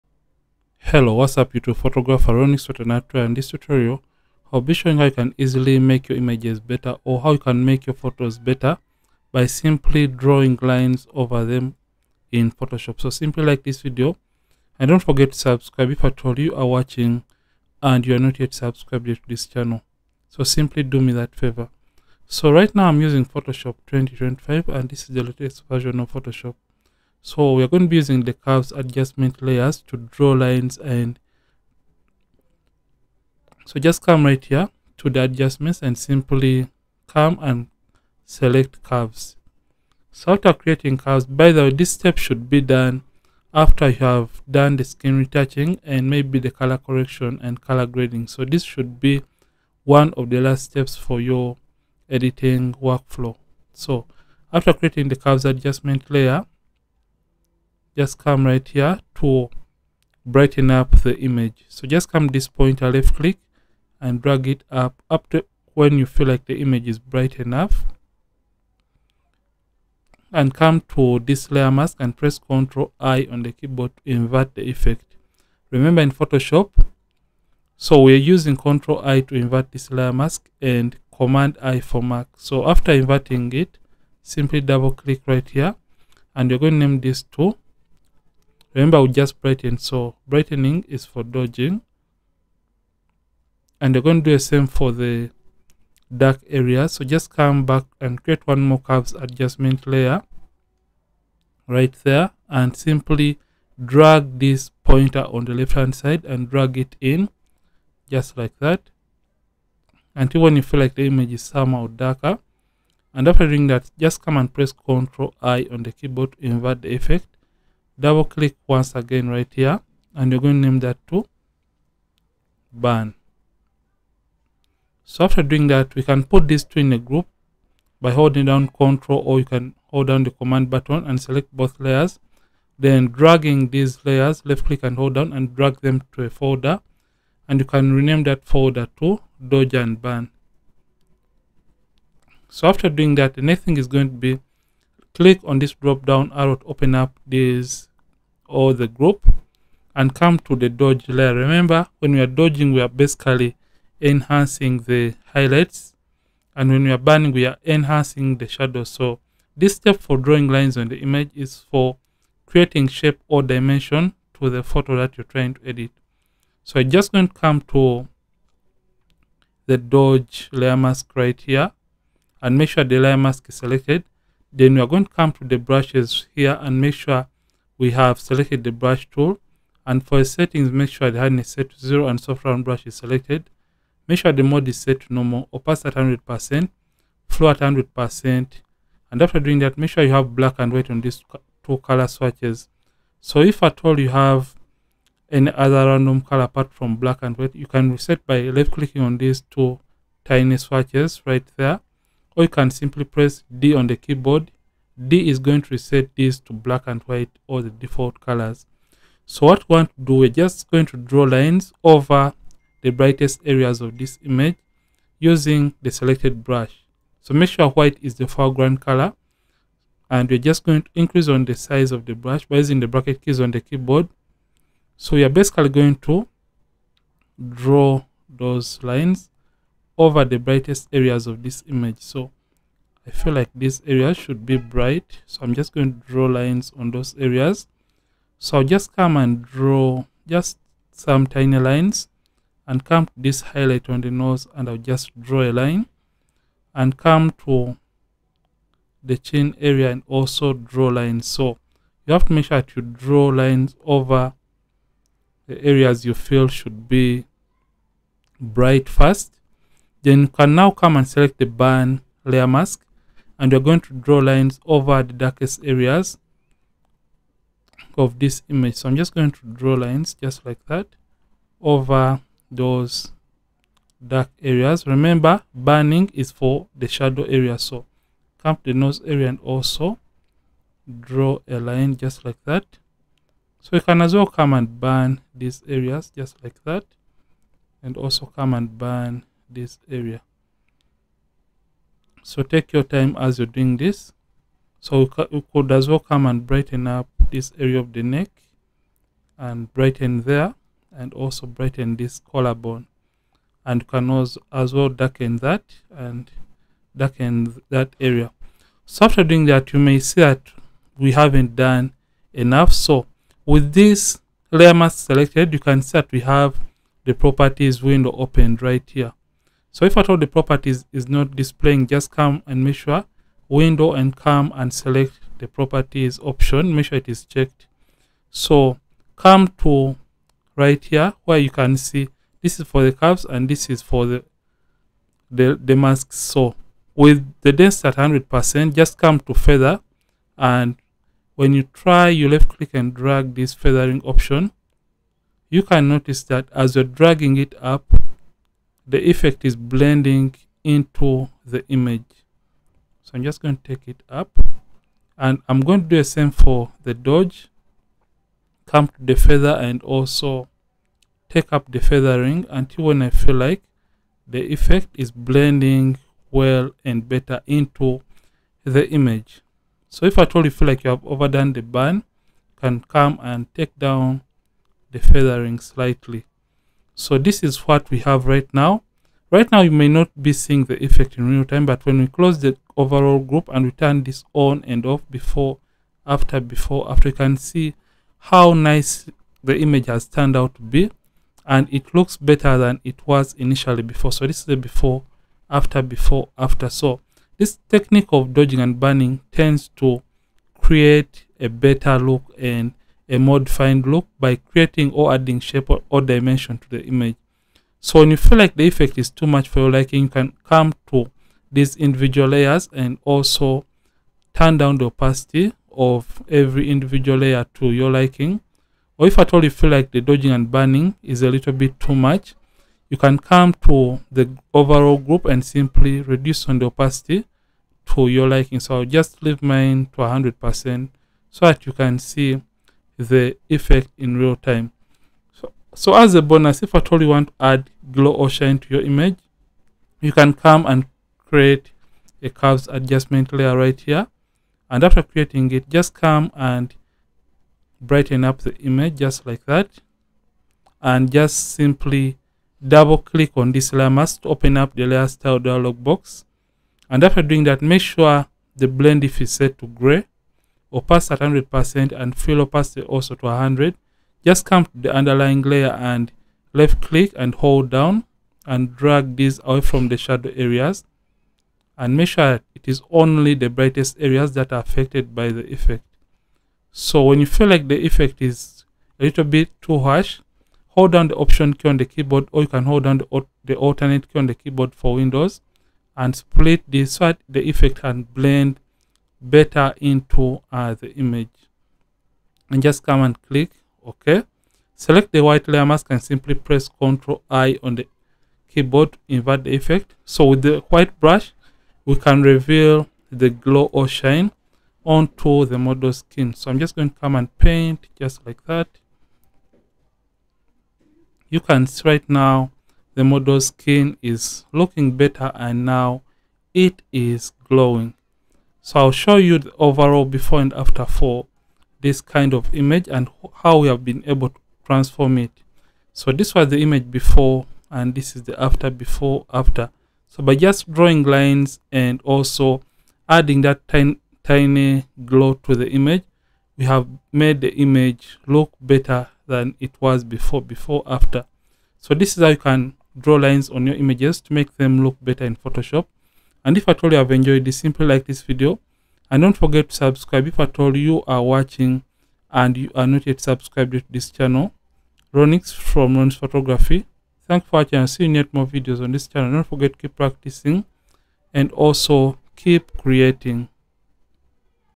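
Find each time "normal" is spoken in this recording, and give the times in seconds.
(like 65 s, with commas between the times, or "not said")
185 s.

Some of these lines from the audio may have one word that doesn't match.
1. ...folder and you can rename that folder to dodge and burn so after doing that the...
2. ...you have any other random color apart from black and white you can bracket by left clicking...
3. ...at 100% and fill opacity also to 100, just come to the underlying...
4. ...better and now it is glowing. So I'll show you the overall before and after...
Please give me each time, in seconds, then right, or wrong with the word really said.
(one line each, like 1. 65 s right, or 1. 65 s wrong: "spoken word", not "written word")
1. 136 s right
2. 193 s wrong: "reset", not "bracket"
3. 461 s right
4. 514 s right.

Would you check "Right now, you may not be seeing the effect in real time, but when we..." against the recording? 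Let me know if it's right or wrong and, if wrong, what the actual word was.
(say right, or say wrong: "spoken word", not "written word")
right.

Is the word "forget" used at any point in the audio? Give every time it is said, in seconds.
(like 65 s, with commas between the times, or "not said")
14 s, 549 s, 559 s.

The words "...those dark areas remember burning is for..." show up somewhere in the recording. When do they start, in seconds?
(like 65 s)
272 s.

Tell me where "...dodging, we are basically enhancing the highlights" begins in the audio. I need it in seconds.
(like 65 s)
152 s.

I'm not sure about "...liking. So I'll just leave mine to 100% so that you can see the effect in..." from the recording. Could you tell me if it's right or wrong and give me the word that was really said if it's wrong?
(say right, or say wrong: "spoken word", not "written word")
right.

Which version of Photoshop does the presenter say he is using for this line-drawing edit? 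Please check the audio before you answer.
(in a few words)
Photoshop 2025.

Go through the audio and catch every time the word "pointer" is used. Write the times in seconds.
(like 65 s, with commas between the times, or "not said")
62 s, 104 s.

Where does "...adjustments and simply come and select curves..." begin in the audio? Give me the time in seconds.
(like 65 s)
35 s.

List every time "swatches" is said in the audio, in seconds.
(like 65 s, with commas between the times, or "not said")
192 s, 200 s.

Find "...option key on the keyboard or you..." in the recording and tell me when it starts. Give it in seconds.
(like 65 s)
481 s.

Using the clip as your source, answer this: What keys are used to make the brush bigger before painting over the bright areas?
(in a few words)
bracket keys.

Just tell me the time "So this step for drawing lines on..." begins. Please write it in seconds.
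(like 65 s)
158 s.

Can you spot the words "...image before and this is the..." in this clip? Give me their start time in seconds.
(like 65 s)
526 s.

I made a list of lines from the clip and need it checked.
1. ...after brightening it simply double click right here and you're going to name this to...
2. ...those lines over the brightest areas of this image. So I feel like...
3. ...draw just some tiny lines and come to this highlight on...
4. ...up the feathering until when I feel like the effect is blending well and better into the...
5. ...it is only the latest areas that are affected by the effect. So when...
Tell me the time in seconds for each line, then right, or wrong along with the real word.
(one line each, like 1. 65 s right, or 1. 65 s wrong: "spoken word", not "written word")
1. 82 s wrong: "inverting", not "brightening"
2. 228 s right
3. 239 s right
4. 361 s right
5. 472 s wrong: "brightest", not "latest".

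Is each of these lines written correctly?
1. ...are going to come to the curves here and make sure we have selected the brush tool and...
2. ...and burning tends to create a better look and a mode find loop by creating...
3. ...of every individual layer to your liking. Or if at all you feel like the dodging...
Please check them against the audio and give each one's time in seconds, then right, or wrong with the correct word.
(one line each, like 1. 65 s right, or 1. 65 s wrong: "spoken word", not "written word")
1. 174 s wrong: "brushes", not "curves"
2. 398 s right
3. 415 s right.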